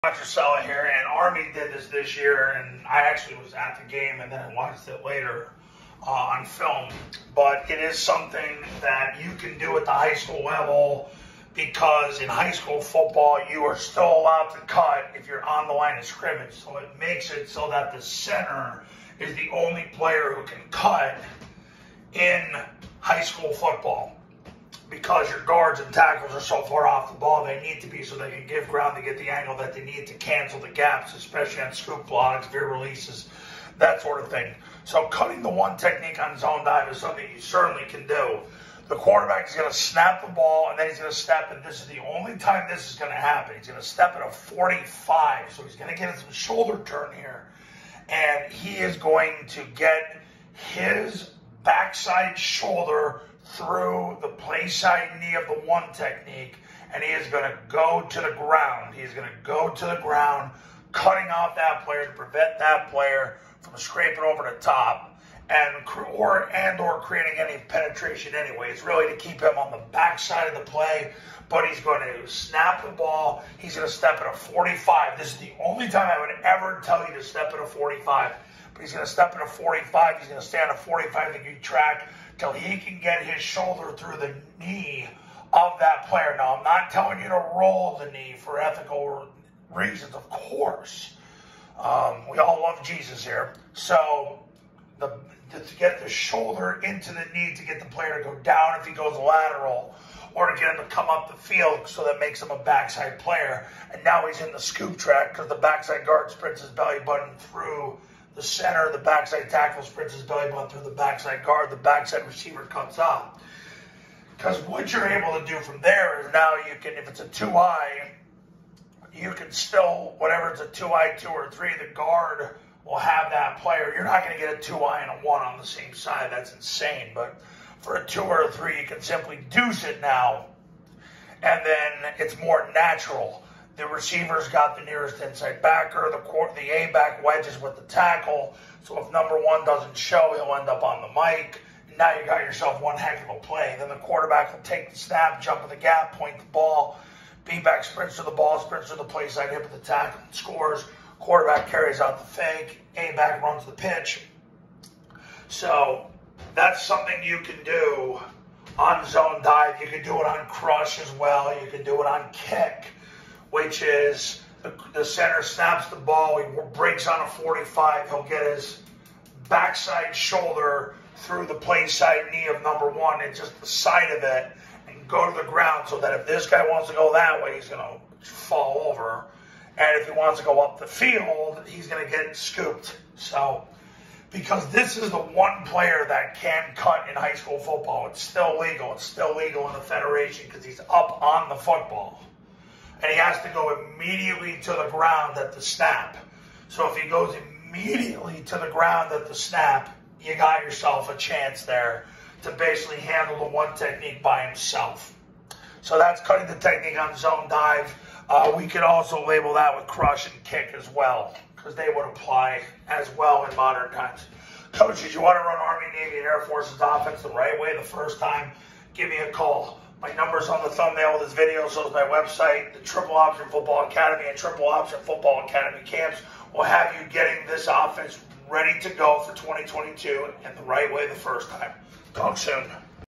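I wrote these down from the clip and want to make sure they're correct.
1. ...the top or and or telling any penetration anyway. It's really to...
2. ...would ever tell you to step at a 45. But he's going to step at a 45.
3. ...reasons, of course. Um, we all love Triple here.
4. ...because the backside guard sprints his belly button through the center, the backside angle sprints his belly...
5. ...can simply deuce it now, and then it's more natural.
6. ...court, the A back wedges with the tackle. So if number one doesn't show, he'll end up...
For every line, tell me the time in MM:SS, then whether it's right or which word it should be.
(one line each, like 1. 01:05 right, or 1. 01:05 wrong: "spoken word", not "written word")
1. 01:04 wrong: "creating", not "telling"
2. 01:16 right
3. 01:29 wrong: "Jesus", not "Triple"
4. 01:45 wrong: "tackle", not "angle"
5. 02:08 right
6. 02:16 right.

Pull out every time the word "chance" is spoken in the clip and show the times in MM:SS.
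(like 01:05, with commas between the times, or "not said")
03:21.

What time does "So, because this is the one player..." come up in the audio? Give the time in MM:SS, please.
03:03.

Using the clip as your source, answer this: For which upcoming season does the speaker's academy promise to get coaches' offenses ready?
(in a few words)
2022.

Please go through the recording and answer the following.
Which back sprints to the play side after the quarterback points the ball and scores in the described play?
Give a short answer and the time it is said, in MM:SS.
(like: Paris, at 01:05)
B back, at 02:27.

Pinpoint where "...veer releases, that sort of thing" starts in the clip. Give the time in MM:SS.
00:32.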